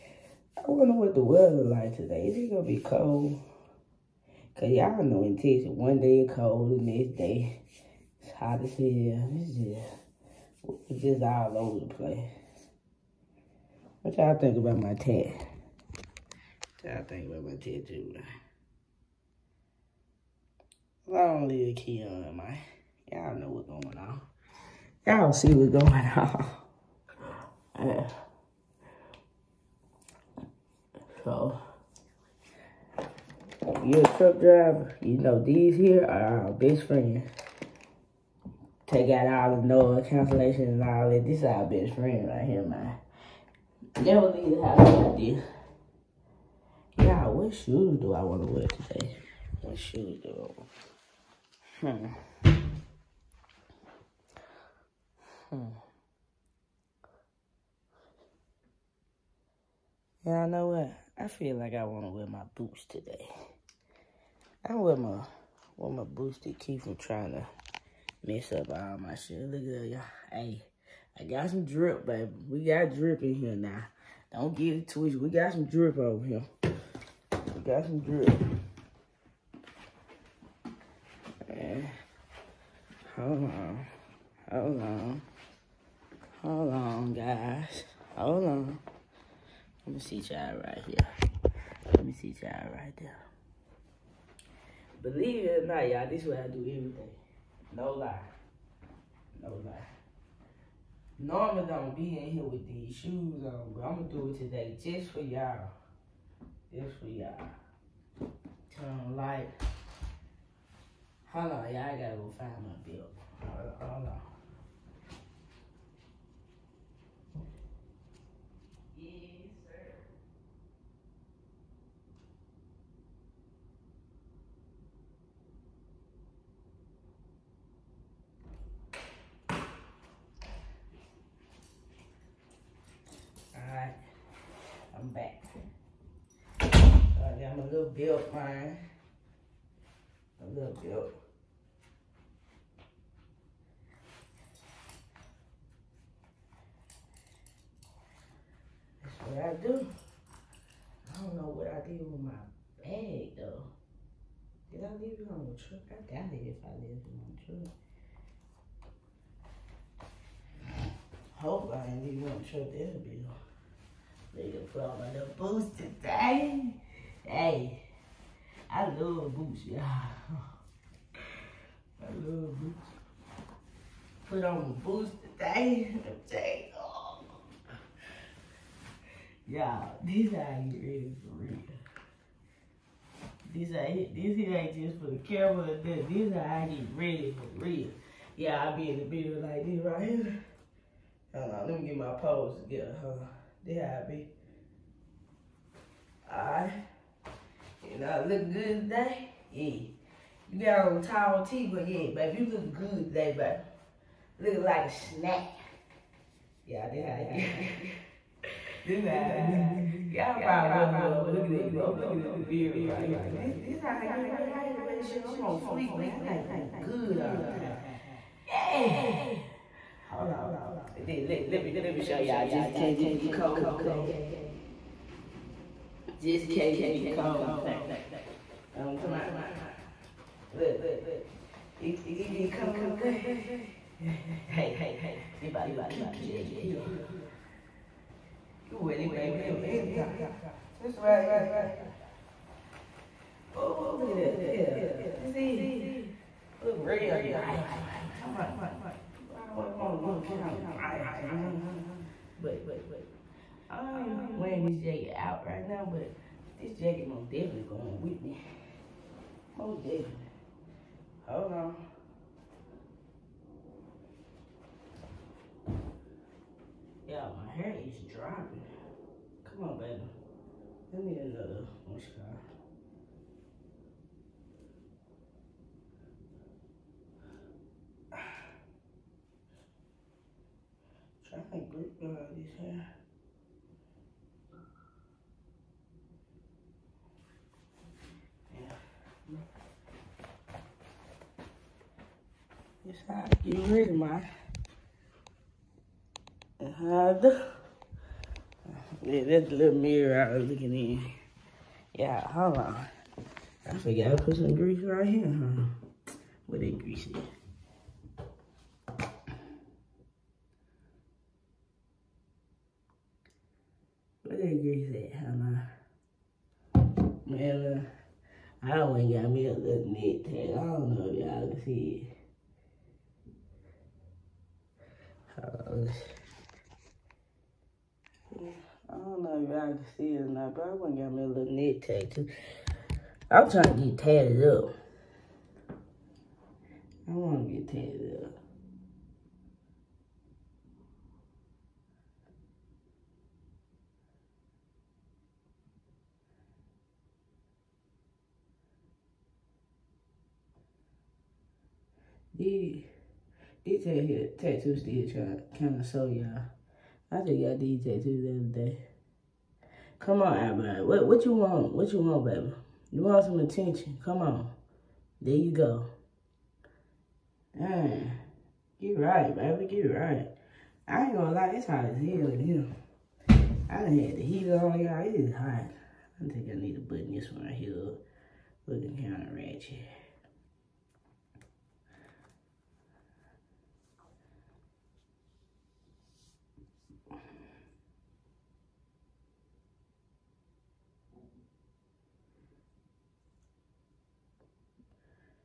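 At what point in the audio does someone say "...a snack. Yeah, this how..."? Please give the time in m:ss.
3:24.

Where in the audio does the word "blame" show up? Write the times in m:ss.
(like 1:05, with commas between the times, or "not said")
not said.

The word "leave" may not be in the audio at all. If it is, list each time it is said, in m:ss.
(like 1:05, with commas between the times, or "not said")
0:44, 2:34, 2:42, 3:55.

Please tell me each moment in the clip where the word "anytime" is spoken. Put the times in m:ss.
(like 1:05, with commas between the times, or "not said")
4:01.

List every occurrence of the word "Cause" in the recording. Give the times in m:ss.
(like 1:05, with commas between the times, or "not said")
0:04.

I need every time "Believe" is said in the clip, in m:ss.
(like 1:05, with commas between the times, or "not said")
1:35.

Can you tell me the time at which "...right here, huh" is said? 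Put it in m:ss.
5:04.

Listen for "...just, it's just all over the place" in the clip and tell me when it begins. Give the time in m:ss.
0:09.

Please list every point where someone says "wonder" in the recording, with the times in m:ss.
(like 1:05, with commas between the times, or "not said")
0:00, 3:30.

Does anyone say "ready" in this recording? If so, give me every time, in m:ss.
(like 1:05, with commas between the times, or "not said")
3:00, 3:06, 3:34, 3:58.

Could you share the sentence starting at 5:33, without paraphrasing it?
I'm trying to get tatted up.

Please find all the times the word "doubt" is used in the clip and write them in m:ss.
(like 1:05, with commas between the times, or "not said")
2:36.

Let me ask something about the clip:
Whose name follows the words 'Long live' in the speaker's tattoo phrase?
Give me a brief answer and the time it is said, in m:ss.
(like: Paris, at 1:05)
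Keon, at 0:21.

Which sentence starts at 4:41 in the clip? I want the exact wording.
I think Luke will have these here.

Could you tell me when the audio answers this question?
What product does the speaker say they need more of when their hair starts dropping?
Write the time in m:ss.
4:31.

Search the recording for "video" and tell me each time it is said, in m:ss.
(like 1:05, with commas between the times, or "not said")
3:09.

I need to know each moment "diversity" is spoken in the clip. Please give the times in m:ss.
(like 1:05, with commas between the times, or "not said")
not said.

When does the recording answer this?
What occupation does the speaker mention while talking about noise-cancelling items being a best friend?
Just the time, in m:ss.
0:34.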